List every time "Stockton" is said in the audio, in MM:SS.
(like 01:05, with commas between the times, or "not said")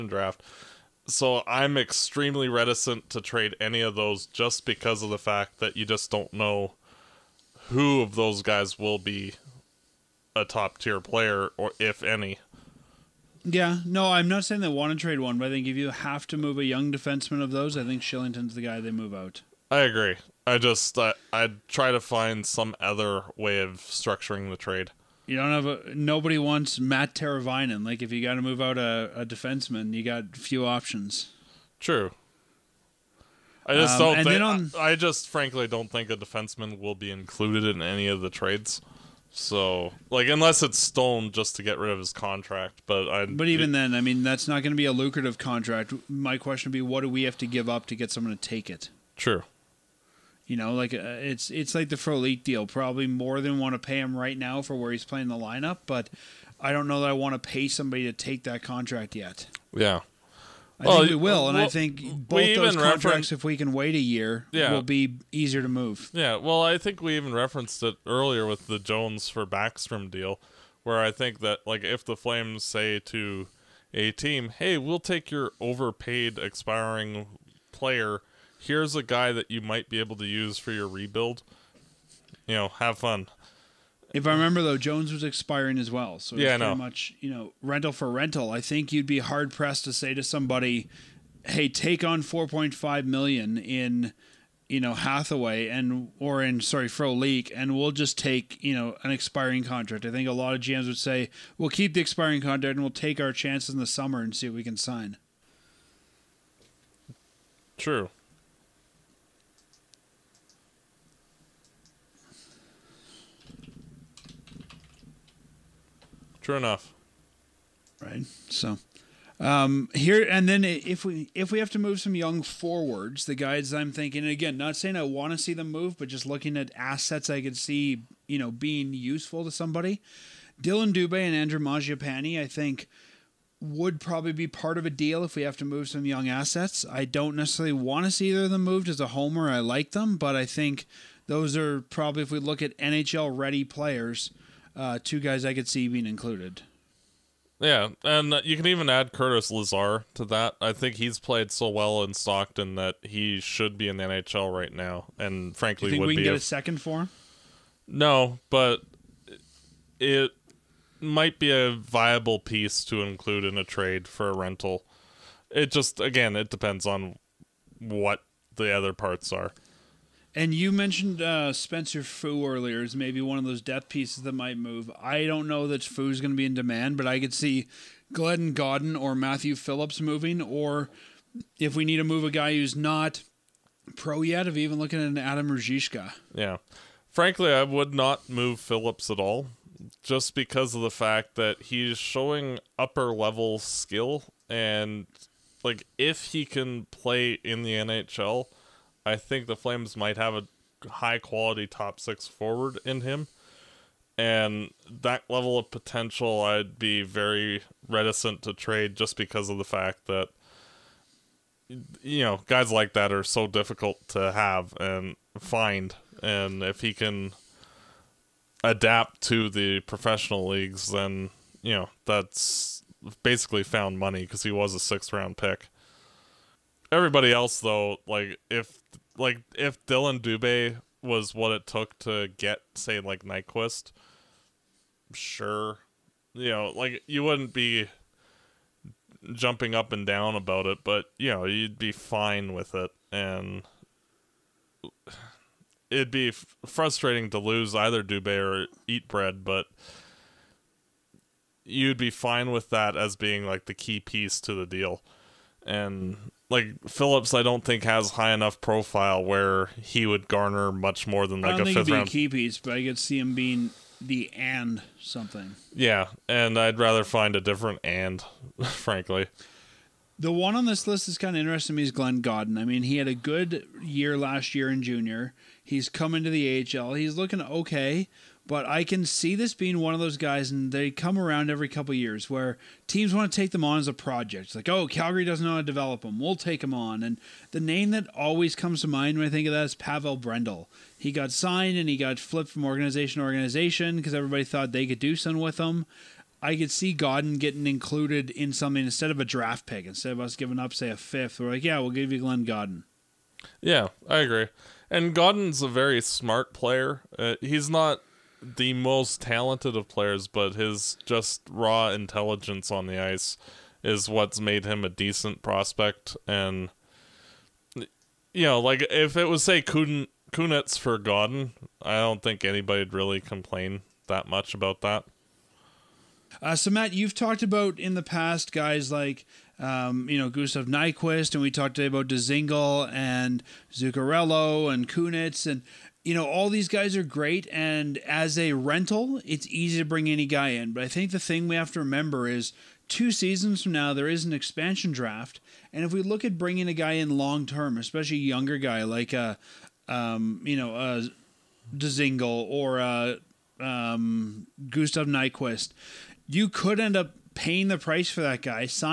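02:32.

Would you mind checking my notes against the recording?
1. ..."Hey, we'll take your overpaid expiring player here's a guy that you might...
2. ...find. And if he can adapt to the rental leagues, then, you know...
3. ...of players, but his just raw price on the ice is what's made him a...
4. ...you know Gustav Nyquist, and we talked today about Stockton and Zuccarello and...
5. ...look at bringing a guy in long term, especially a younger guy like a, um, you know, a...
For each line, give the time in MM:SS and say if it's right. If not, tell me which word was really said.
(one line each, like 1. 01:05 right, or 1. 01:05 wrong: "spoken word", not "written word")
1. 01:14 right
2. 03:35 wrong: "professional", not "rental"
3. 05:09 wrong: "intelligence", not "price"
4. 05:30 wrong: "Dzingel", not "Stockton"
5. 05:46 right.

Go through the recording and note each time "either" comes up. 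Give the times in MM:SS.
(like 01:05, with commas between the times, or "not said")
02:18, 04:07.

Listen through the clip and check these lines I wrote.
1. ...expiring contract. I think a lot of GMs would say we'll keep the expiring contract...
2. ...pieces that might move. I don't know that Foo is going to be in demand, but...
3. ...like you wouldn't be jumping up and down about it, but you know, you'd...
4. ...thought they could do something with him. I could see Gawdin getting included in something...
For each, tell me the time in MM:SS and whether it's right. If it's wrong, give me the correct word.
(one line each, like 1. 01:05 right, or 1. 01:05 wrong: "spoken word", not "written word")
1. 01:39 right
2. 02:53 right
3. 03:56 right
4. 04:54 right.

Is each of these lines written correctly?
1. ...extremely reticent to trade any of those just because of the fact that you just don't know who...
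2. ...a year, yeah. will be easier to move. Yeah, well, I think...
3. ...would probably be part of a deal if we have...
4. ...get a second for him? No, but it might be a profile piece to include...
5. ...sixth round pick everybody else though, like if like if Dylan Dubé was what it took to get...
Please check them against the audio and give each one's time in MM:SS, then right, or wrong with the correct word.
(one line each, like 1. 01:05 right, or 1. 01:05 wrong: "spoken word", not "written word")
1. 00:01 right
2. 01:03 right
3. 02:13 right
4. 02:36 wrong: "viable", not "profile"
5. 03:44 right.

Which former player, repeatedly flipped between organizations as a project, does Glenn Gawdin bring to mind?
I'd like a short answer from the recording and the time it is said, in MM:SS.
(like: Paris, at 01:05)
Pavel Brendl, at 04:49.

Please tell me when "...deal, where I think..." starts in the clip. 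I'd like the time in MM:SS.
01:10.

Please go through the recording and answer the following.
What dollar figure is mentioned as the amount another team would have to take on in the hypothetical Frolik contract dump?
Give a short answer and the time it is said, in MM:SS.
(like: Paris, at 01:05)
4.5 million, at 01:32.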